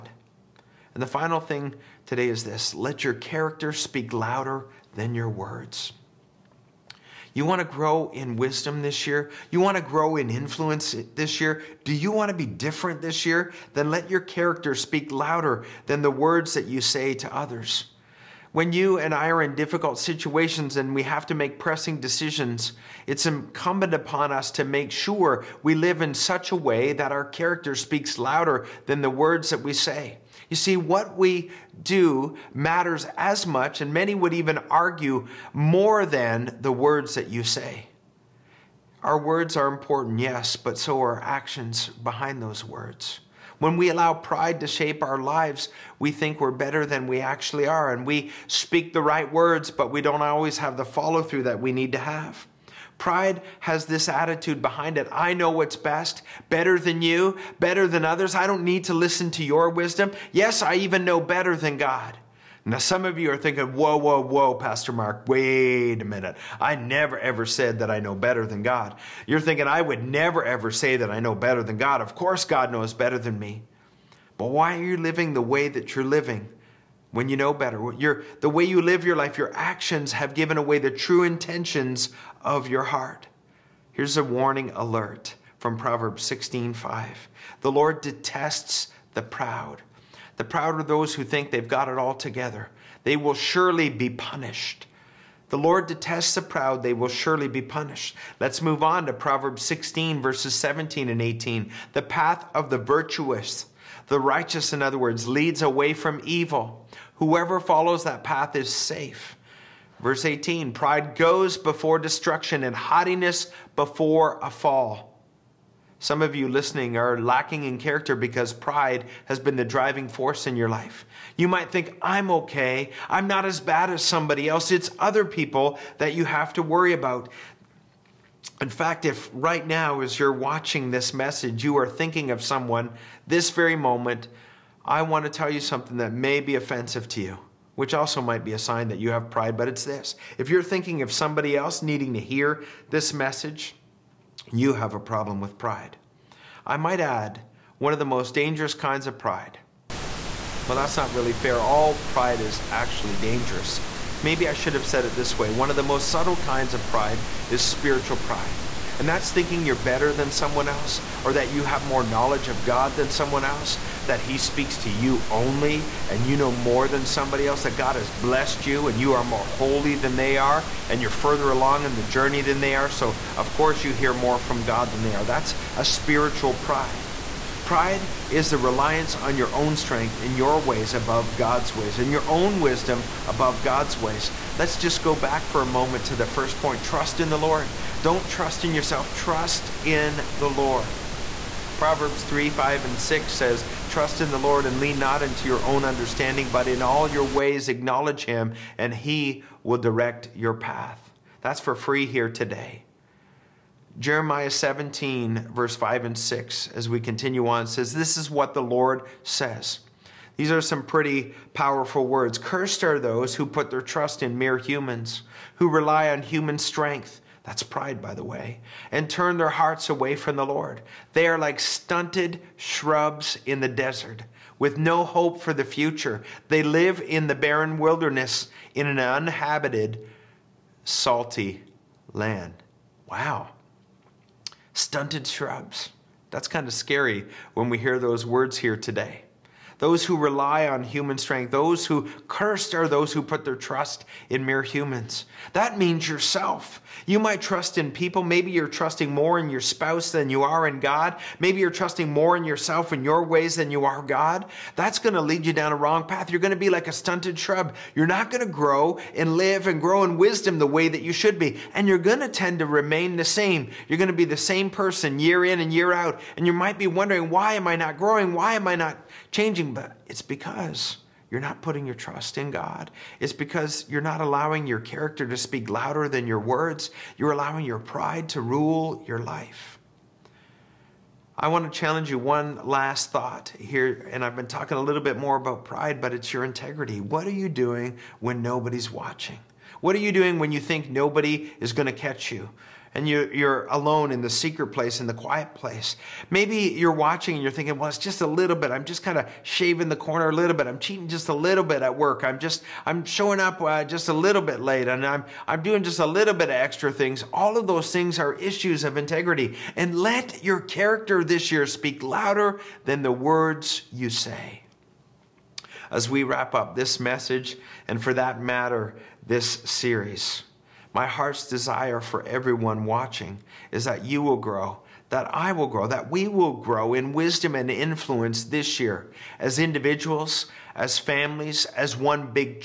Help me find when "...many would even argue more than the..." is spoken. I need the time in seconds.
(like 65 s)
33 s.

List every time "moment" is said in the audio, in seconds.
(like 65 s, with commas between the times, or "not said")
133 s, 185 s.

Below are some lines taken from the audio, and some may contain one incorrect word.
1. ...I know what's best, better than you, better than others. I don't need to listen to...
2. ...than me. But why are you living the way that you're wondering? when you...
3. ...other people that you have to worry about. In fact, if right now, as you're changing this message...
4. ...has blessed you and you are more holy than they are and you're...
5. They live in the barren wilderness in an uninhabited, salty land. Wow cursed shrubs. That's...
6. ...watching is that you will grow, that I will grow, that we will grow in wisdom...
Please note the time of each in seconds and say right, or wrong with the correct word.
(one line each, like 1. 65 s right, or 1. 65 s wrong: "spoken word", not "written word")
1. 55 s right
2. 73 s wrong: "living", not "wondering"
3. 124 s wrong: "watching", not "changing"
4. 167 s right
5. 226 s wrong: "stunted", not "cursed"
6. 322 s right.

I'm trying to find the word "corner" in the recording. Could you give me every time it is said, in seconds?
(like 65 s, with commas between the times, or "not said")
299 s.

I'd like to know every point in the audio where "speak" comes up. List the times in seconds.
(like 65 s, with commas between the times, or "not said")
3 s, 14 s, 27 s, 48 s, 164 s, 275 s, 311 s.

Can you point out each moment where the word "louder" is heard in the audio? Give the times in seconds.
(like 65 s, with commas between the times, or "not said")
4 s, 15 s, 28 s, 275 s, 312 s.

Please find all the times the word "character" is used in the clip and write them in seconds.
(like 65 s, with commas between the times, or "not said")
3 s, 14 s, 27 s, 117 s, 274 s, 310 s.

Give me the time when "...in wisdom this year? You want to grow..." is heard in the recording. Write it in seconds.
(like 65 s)
8 s.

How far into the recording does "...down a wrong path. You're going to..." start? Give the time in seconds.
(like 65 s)
255 s.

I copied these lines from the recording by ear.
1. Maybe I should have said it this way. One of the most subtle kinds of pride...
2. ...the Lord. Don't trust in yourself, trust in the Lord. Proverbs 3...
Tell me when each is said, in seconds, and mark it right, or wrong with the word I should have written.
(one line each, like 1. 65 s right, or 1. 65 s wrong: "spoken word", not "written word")
1. 154 s right
2. 187 s right.